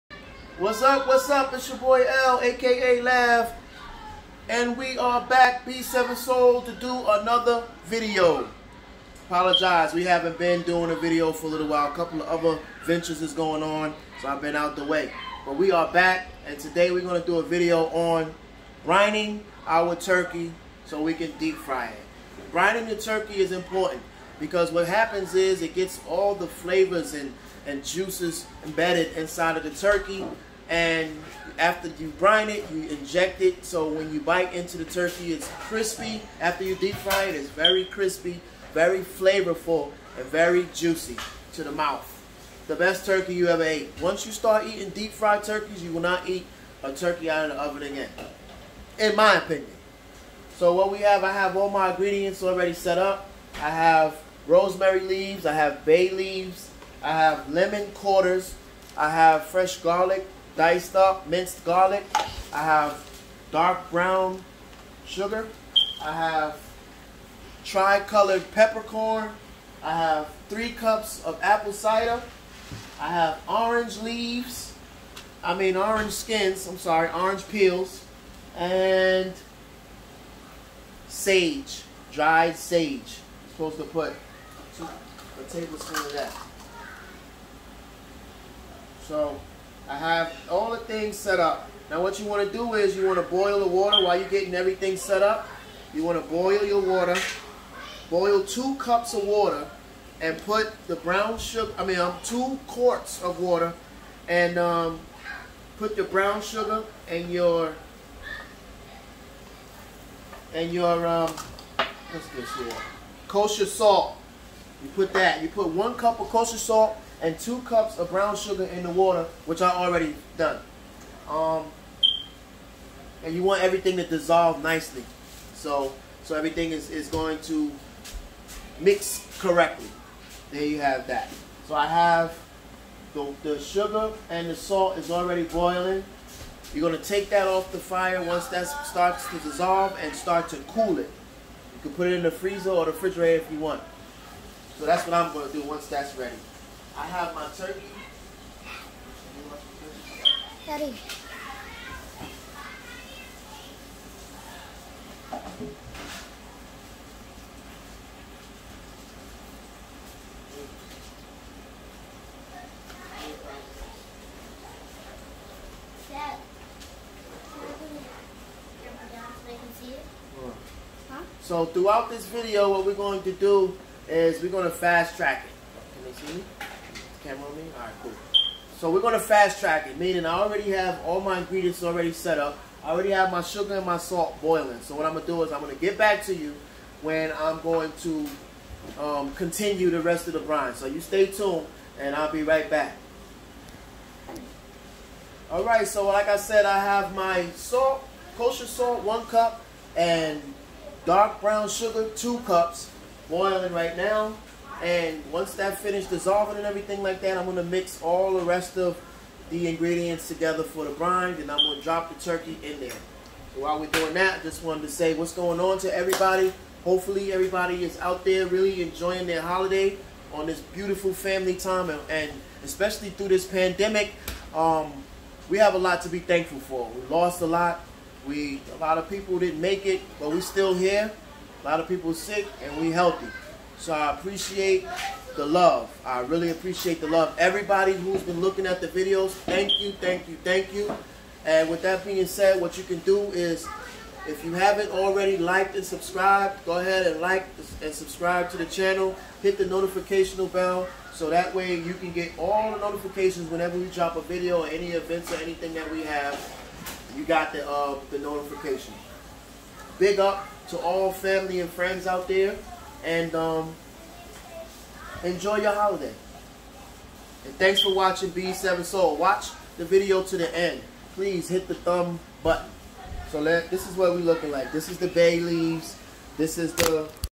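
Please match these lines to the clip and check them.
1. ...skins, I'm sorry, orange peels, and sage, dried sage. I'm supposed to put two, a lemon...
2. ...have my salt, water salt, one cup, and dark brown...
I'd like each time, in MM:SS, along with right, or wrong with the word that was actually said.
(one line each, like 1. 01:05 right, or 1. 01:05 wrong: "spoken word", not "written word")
1. 01:16 wrong: "tablespoon", not "lemon"
2. 03:16 wrong: "kosher", not "water".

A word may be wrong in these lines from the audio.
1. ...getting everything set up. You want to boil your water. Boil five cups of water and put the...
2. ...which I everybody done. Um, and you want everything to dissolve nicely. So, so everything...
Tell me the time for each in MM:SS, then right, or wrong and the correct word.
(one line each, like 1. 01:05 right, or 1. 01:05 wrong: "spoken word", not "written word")
1. 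01:34 wrong: "two", not "five"
2. 01:59 wrong: "already", not "everybody".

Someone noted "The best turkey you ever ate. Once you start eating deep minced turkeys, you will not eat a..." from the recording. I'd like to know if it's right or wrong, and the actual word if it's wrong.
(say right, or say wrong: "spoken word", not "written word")
wrong: "fried", not "minced".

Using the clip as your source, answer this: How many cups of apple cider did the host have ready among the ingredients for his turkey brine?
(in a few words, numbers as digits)
3.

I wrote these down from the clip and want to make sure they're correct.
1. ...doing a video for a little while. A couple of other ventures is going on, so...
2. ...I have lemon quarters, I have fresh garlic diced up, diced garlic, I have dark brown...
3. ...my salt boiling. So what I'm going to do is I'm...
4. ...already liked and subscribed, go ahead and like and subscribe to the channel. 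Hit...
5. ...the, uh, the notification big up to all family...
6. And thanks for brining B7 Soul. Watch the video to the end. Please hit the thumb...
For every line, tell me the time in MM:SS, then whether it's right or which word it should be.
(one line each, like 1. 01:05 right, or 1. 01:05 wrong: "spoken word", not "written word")
1. 00:10 right
2. 00:57 wrong: "minced", not "diced"
3. 03:03 right
4. 04:04 right
5. 04:17 right
6. 04:27 wrong: "watching", not "brining".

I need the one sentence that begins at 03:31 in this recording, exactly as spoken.
and I'm going to drop the turkey in there.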